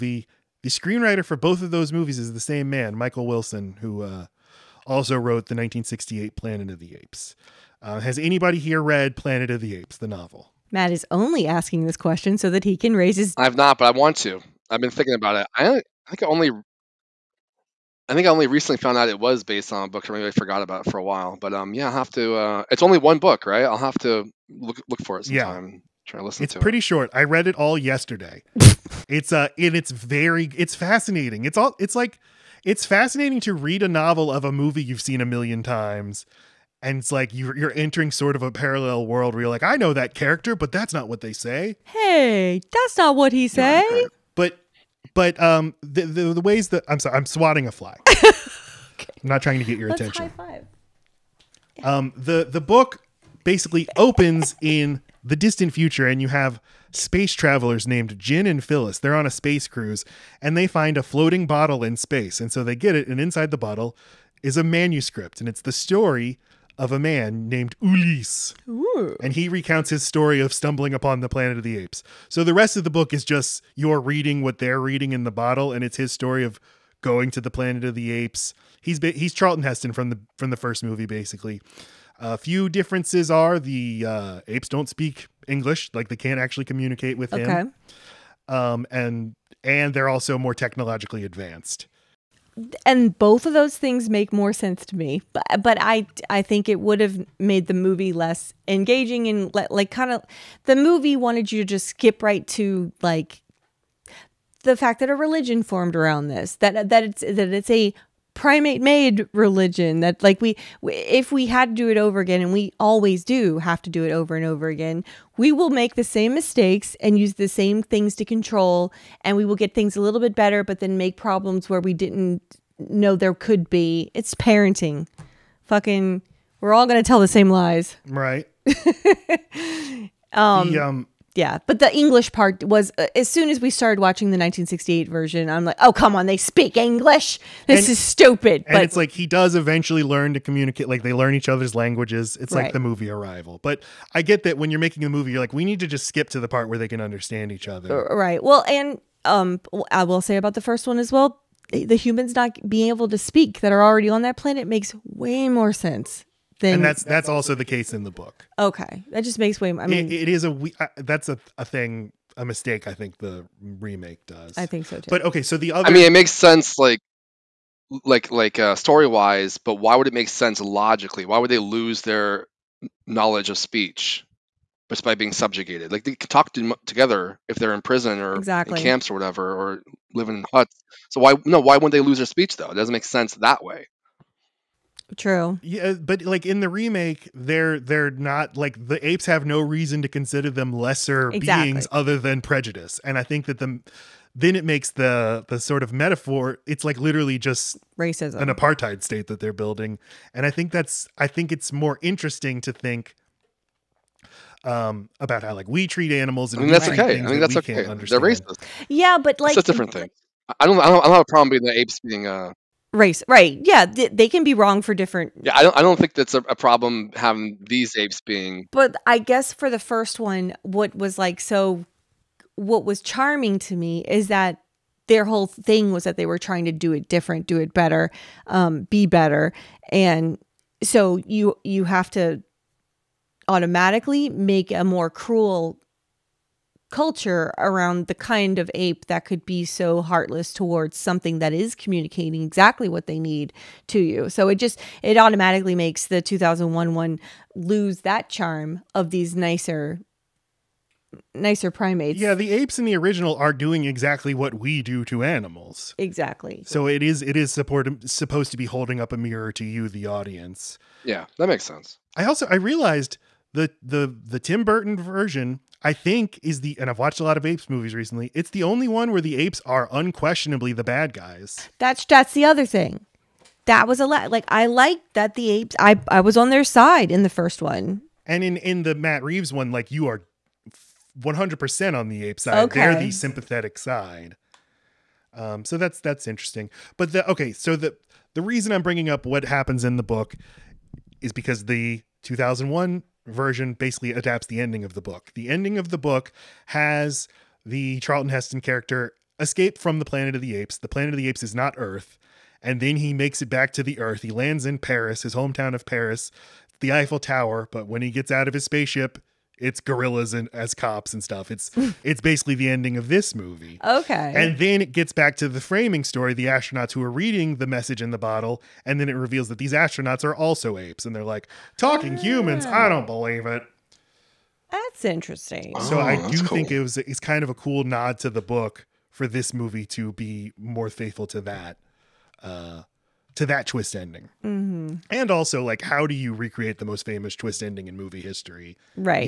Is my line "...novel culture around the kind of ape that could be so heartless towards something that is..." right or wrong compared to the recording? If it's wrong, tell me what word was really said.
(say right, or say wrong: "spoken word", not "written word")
wrong: "cruel", not "novel".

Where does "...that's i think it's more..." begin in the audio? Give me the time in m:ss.
3:20.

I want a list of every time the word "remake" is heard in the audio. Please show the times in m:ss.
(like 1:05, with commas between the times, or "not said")
2:43, 3:06.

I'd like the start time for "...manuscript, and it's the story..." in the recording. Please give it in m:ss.
1:04.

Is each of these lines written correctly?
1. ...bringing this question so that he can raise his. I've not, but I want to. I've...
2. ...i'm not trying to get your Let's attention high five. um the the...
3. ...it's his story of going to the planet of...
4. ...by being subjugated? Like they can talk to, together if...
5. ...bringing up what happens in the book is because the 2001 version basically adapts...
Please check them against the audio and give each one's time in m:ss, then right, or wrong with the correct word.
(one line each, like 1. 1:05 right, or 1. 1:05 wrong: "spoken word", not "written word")
1. 0:11 wrong: "asking", not "bringing"
2. 0:49 right
3. 1:15 right
4. 2:55 right
5. 4:48 right.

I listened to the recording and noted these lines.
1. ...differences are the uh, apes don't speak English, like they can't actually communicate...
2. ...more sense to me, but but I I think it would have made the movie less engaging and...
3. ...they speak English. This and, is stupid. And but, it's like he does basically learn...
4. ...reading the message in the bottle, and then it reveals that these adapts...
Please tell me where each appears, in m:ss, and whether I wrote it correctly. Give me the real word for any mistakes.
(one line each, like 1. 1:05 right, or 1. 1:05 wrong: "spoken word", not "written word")
1. 1:22 right
2. 1:34 right
3. 2:16 wrong: "eventually", not "basically"
4. 5:17 wrong: "astronauts", not "adapts".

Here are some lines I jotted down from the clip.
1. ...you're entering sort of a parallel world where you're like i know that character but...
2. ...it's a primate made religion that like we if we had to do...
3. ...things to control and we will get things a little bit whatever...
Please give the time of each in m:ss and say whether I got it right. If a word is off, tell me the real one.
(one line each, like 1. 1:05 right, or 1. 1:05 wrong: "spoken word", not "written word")
1. 0:37 right
2. 1:47 right
3. 1:57 wrong: "better", not "whatever".